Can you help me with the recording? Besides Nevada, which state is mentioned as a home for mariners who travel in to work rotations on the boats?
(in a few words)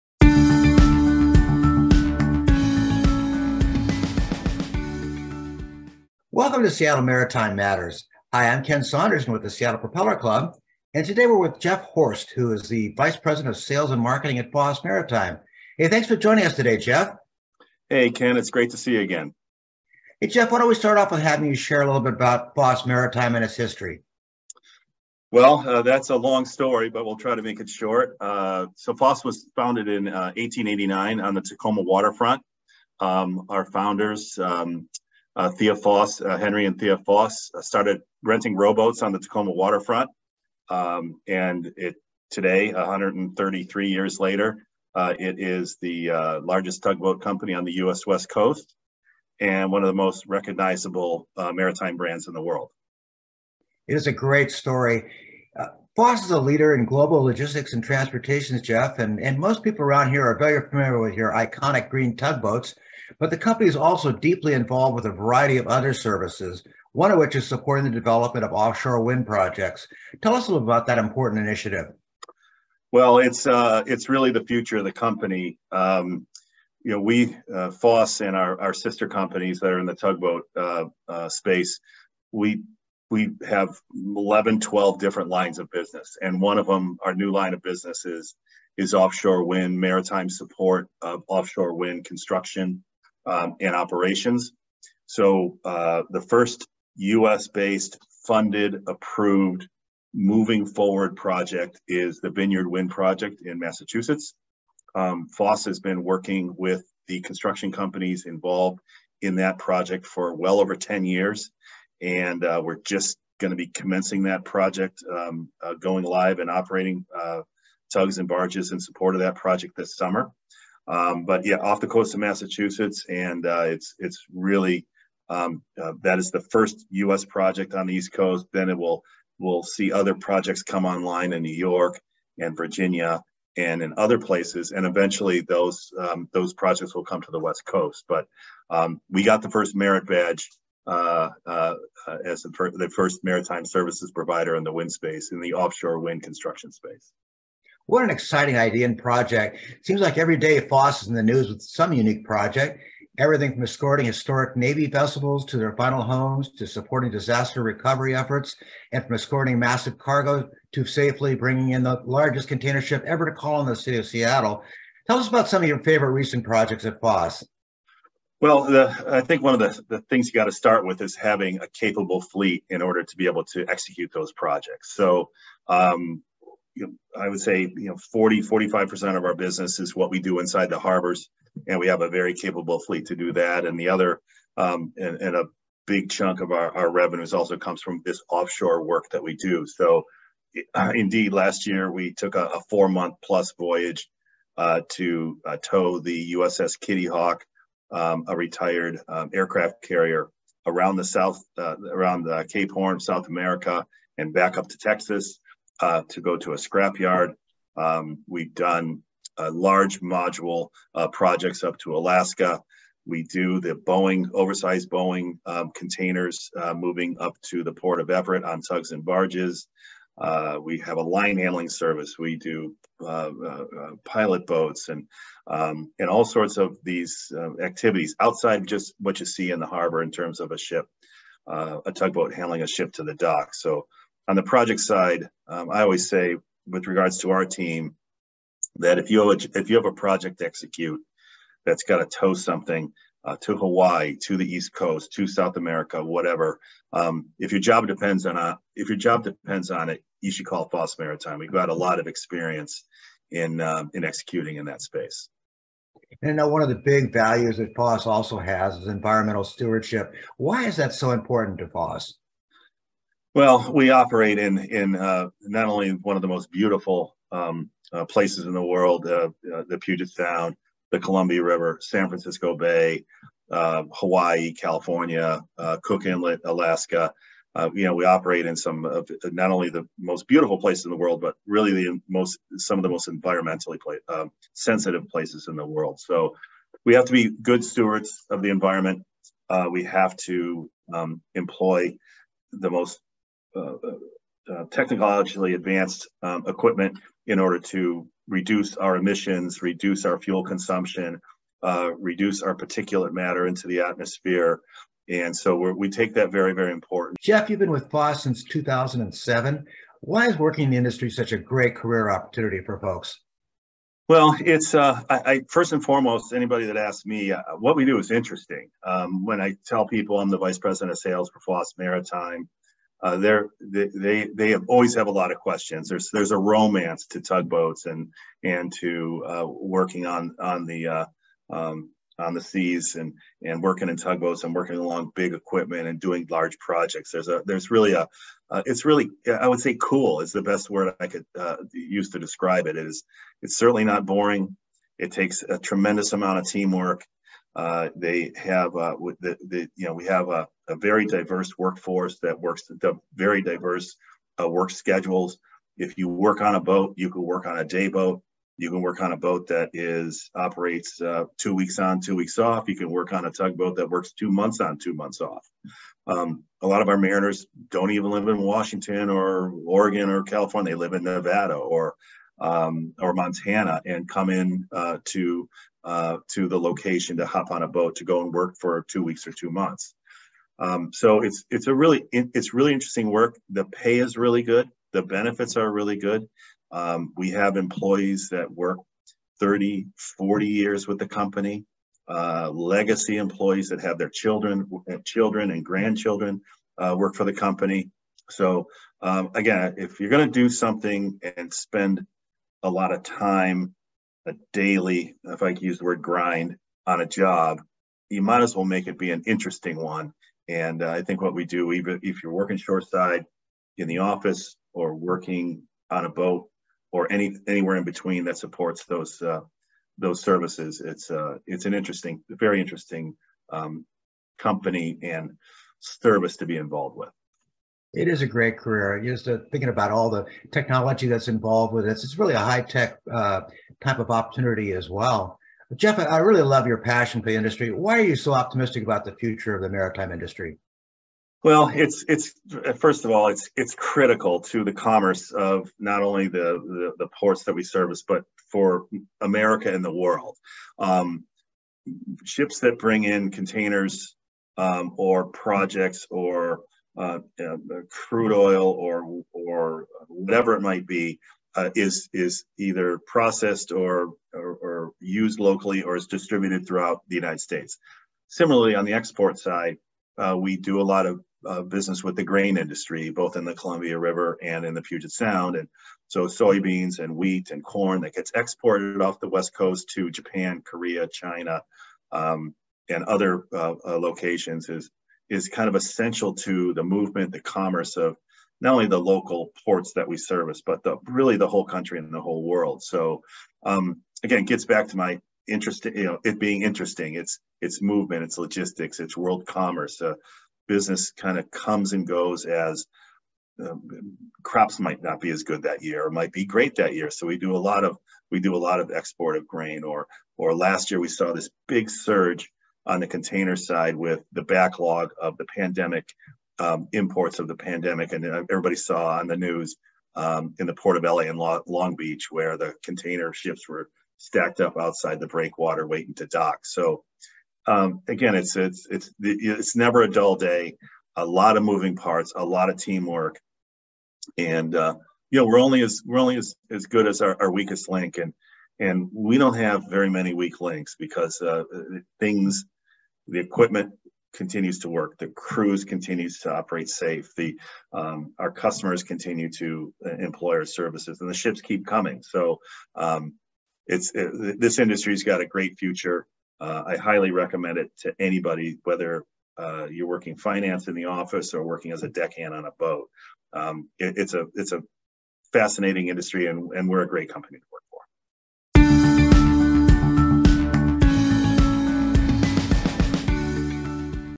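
Montana.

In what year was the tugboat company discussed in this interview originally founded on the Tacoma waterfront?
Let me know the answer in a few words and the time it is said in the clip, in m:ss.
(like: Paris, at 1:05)
1889, at 0:30.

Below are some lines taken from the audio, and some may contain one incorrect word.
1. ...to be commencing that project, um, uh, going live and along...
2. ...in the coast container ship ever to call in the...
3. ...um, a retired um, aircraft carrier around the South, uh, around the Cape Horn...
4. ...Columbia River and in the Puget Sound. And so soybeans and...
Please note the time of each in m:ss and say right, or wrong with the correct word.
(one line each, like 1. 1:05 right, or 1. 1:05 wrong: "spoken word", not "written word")
1. 1:53 wrong: "operating", not "along"
2. 2:41 wrong: "largest", not "coast"
3. 3:17 right
4. 7:53 right.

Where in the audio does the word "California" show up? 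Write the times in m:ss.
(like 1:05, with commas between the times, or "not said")
4:34, 6:10.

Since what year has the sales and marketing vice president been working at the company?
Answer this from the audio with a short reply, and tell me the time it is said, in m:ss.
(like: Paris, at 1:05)
2007, at 5:08.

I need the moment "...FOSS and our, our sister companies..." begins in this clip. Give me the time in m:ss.
1:17.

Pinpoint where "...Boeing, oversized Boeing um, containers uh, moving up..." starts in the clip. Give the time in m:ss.
3:33.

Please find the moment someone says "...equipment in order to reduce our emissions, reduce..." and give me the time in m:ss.
4:56.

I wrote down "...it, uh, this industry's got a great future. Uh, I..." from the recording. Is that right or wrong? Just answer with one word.
right.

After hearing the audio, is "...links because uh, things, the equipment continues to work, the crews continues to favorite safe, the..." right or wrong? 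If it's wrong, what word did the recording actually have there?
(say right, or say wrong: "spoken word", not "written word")
wrong: "operate", not "favorite".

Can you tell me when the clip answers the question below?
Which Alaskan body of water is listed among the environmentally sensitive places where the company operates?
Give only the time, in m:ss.
4:35.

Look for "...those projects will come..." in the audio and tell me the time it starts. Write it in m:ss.
2:16.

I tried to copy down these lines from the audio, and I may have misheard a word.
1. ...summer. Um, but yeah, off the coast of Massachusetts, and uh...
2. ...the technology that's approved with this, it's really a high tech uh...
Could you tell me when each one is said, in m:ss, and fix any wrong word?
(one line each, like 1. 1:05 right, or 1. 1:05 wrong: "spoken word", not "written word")
1. 1:59 right
2. 7:10 wrong: "involved", not "approved".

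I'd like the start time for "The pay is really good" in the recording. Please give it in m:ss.
6:23.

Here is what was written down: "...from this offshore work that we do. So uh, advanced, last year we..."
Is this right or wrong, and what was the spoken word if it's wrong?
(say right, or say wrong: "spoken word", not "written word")
wrong: "indeed", not "advanced".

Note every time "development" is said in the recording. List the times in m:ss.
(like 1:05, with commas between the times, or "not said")
1:07.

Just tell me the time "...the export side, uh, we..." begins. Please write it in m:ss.
7:48.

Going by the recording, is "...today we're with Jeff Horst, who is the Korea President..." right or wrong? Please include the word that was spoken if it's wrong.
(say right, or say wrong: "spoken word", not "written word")
wrong: "Vice", not "Korea".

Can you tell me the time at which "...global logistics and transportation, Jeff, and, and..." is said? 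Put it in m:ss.
0:56.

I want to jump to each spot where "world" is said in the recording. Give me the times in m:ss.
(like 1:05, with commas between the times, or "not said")
0:52, 4:28, 4:40, 4:45, 7:29, 8:12, 8:19.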